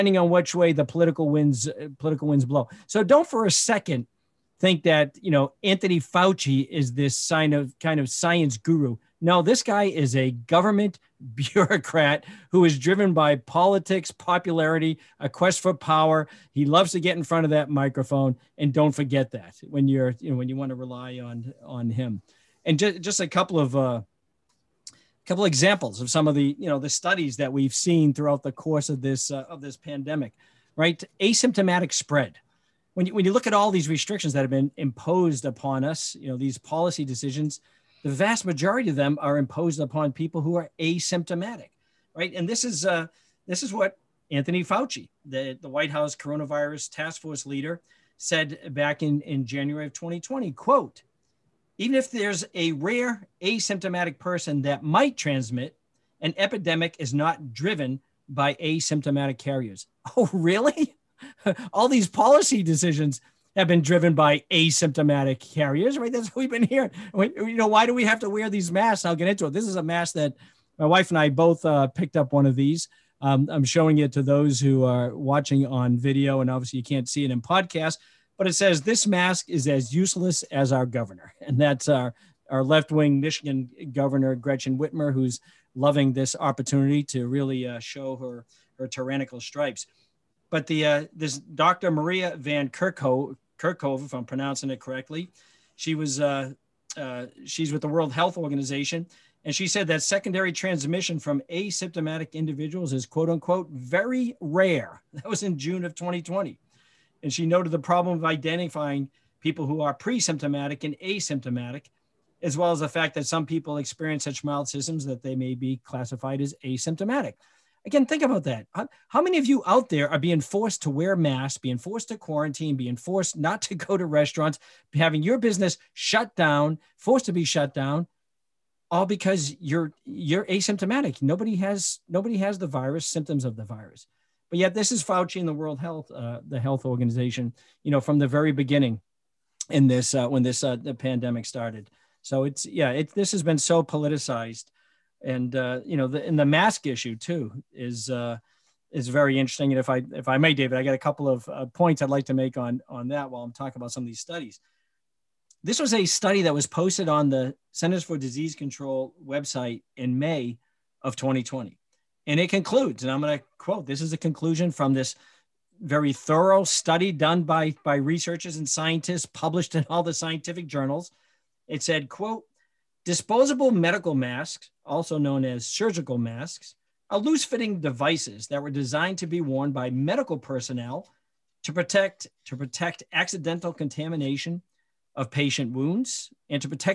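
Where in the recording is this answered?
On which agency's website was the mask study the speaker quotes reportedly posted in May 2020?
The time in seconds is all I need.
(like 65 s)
157 s.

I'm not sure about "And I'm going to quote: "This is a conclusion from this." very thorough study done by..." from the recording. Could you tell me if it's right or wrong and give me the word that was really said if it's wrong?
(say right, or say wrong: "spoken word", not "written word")
right.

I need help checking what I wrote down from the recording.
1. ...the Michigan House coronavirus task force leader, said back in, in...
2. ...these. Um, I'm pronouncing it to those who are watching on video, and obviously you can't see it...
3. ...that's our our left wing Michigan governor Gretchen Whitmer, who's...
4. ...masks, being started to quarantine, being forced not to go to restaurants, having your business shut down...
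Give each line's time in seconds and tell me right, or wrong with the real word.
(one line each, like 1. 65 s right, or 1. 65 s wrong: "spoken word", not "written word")
1. 45 s wrong: "White", not "Michigan"
2. 72 s wrong: "showing", not "pronouncing"
3. 81 s right
4. 121 s wrong: "forced", not "started".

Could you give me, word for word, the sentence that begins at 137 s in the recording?
You know, from the very beginning, in this uh, when this uh, the pandemic started.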